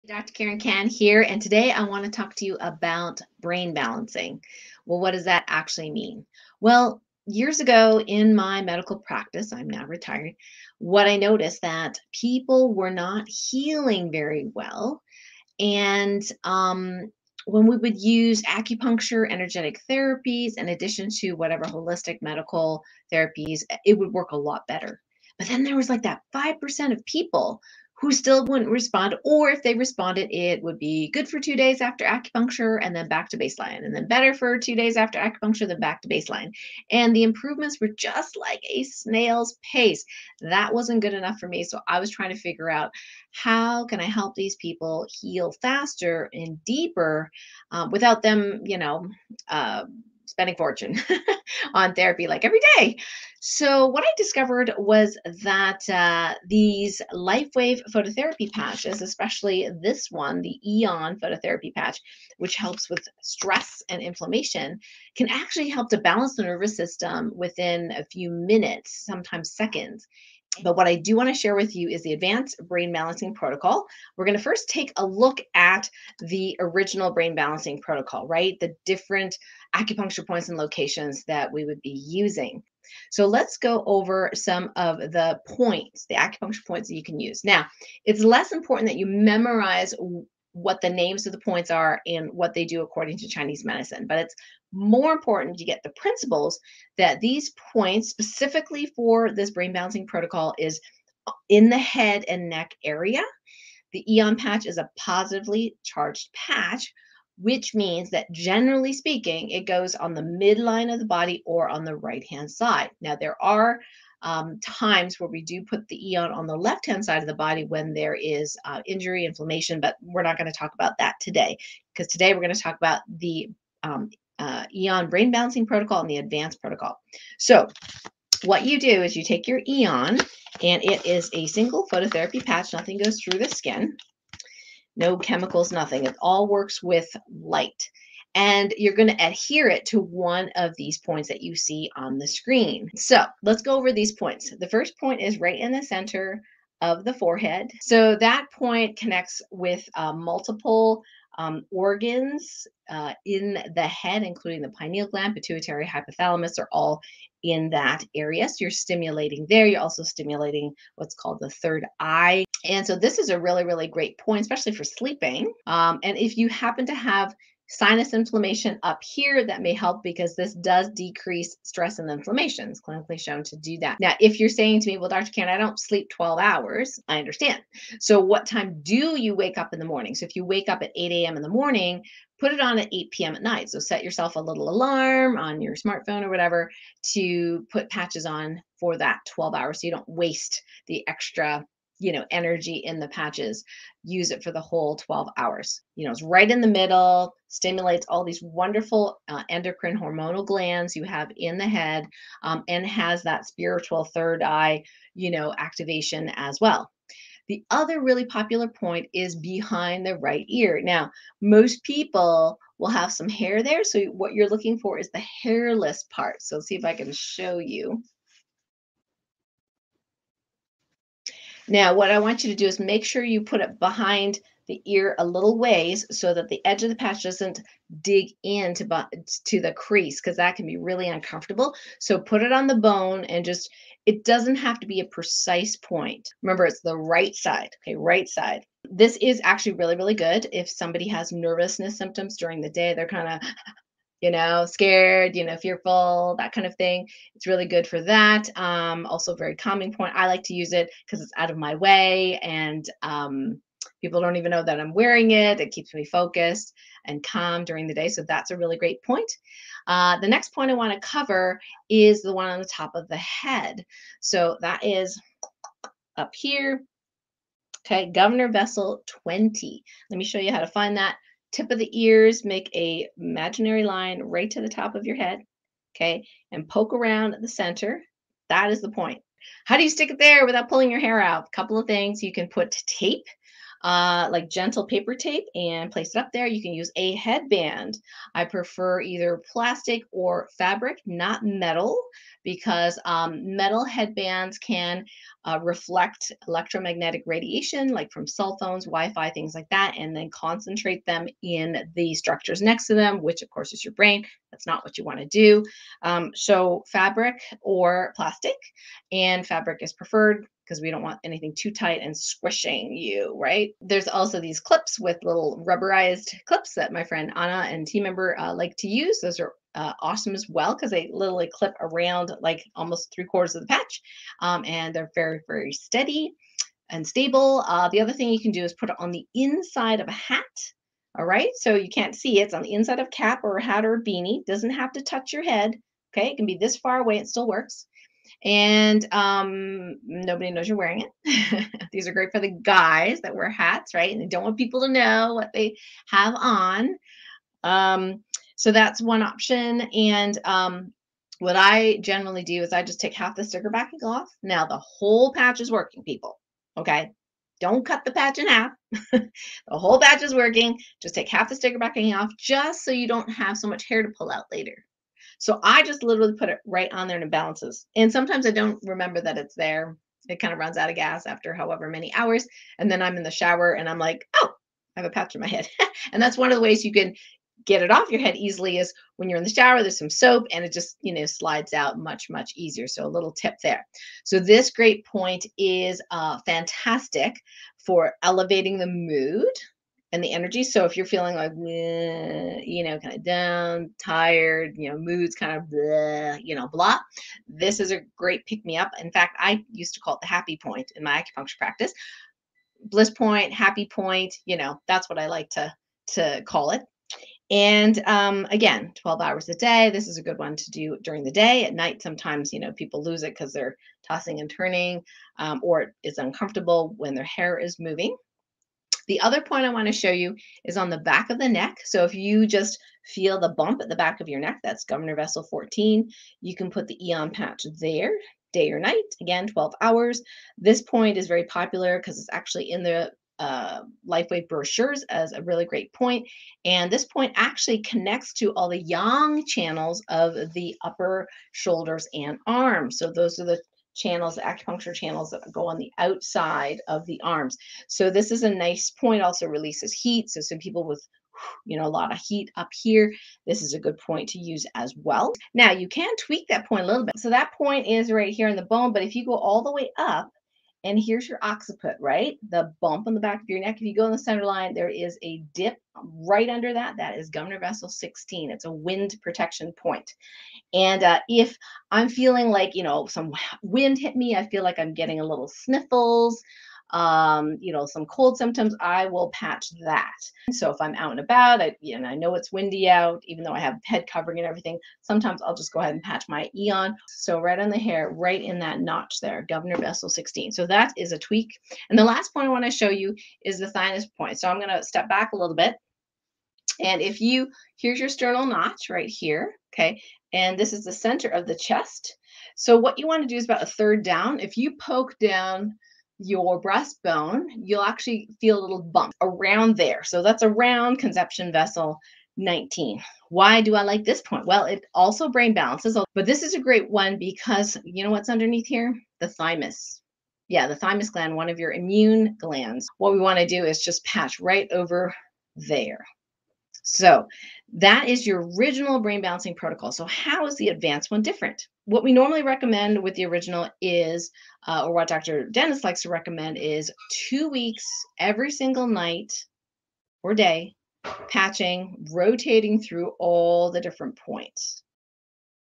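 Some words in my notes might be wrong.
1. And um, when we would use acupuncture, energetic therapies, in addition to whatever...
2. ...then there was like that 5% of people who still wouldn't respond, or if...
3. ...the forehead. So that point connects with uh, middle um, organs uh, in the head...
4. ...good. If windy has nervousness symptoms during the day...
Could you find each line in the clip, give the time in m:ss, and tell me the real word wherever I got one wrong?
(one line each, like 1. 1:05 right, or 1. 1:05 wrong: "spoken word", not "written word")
1. 0:15 right
2. 0:25 right
3. 2:27 wrong: "multiple", not "middle"
4. 4:00 wrong: "somebody", not "windy".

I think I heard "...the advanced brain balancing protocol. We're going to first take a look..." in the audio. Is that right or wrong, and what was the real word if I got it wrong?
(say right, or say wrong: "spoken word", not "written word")
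right.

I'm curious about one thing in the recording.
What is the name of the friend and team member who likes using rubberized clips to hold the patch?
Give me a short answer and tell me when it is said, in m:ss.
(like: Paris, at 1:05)
Anna, at 5:17.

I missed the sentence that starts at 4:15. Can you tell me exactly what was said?
It keeps me focused and calm during the day.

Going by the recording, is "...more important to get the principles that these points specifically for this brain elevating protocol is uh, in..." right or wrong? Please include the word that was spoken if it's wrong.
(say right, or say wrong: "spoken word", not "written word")
wrong: "balancing", not "elevating".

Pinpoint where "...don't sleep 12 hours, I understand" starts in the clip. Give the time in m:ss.
2:55.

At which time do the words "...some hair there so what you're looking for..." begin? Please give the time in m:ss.
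3:33.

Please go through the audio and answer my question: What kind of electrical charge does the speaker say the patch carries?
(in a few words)
positively charged.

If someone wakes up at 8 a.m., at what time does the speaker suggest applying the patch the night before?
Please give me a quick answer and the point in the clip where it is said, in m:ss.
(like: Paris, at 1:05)
8 p.m., at 3:02.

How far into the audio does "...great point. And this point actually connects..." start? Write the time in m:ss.
7:15.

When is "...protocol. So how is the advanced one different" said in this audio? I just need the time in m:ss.
8:49.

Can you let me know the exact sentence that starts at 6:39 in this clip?
In fact, I used to call it the happy point in my acupuncture practice.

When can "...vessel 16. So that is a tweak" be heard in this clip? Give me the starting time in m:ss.
8:09.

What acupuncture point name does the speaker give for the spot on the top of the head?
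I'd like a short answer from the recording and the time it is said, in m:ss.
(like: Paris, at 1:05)
Governor Vessel 20, at 4:28.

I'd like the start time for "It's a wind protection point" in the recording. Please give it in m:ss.
7:48.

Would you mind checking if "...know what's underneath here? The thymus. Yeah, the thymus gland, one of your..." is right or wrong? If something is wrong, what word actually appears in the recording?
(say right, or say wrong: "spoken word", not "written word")
right.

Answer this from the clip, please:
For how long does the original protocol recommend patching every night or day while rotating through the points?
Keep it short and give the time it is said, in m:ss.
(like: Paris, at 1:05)
2 weeks, at 8:57.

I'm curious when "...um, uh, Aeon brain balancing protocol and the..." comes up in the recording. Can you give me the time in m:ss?
2:03.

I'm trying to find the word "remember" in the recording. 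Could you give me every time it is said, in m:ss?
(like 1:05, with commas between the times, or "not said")
3:56, 6:08.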